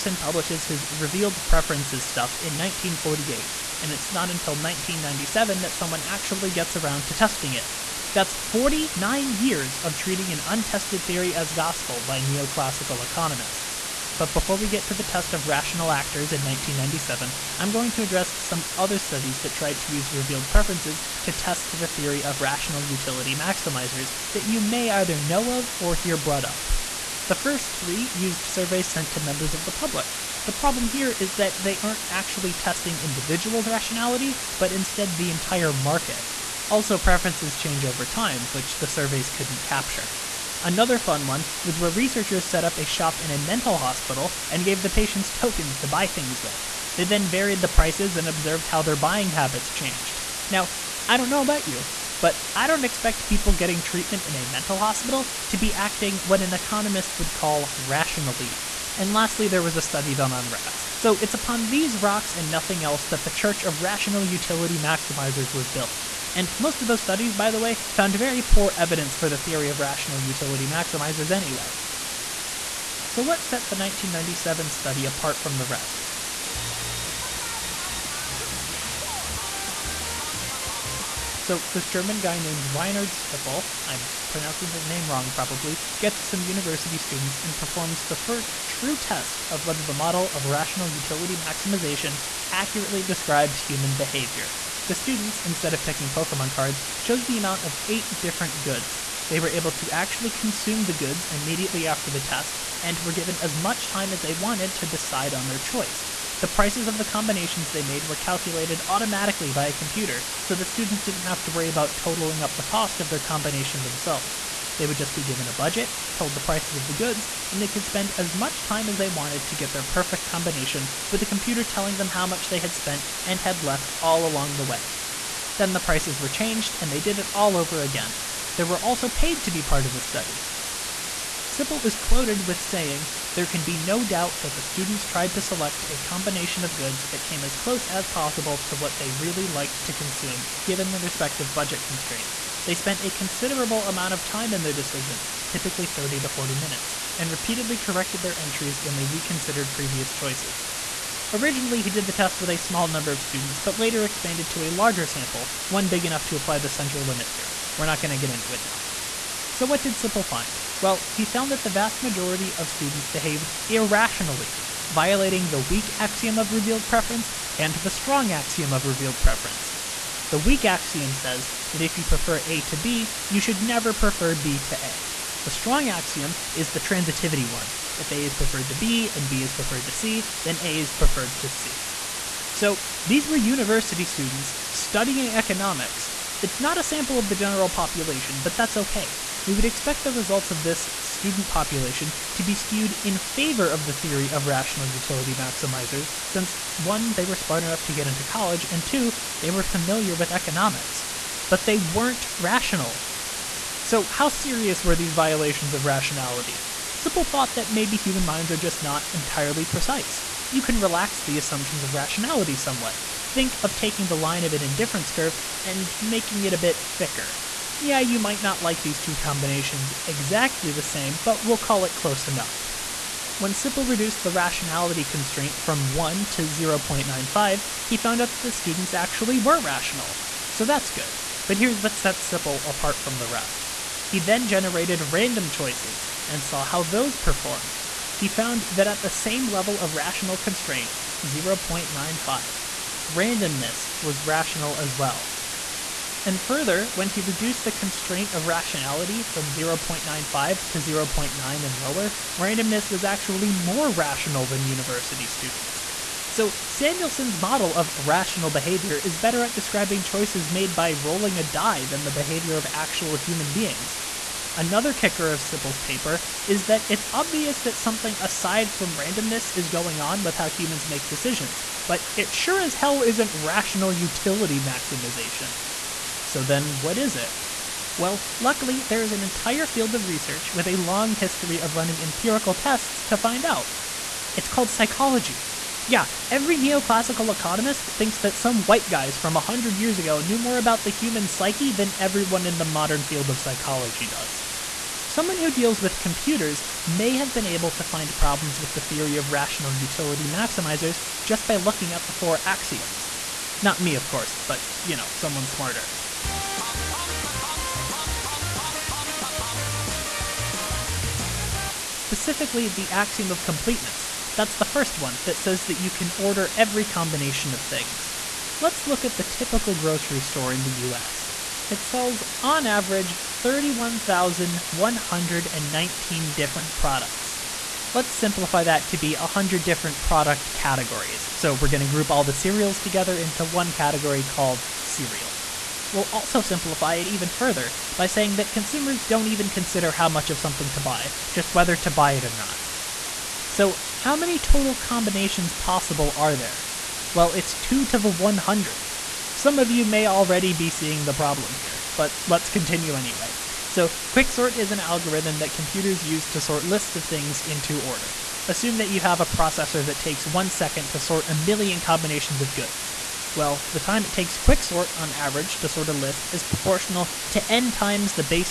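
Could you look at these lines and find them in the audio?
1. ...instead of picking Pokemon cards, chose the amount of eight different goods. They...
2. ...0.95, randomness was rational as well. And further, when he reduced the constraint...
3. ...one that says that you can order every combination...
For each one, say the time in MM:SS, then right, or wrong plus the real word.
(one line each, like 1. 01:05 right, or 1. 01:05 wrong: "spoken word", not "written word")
1. 01:35 right
2. 04:01 right
3. 05:14 right.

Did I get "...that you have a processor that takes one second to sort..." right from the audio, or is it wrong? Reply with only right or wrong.
right.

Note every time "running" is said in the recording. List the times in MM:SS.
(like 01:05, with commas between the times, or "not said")
04:41.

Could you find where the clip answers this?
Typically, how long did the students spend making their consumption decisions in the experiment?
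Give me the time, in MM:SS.
02:25.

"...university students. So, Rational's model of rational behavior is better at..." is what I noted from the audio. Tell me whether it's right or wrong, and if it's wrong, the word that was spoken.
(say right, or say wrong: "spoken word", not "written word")
wrong: "Samuelson", not "Rational".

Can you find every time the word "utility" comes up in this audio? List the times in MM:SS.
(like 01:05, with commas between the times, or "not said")
00:22, 01:04, 01:10, 01:30, 03:14, 04:33, 04:59.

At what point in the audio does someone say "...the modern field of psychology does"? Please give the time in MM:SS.
04:52.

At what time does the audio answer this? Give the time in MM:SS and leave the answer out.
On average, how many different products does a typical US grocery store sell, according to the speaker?
05:23.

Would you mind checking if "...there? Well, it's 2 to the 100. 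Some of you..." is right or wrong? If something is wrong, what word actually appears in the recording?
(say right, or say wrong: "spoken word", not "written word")
right.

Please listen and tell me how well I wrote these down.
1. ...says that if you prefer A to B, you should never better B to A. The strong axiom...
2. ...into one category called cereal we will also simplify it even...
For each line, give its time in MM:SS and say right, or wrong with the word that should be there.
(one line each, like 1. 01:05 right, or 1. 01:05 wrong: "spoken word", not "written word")
1. 02:51 wrong: "prefer", not "better"
2. 05:33 right.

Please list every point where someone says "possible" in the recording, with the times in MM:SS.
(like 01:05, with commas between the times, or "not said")
02:18, 05:45.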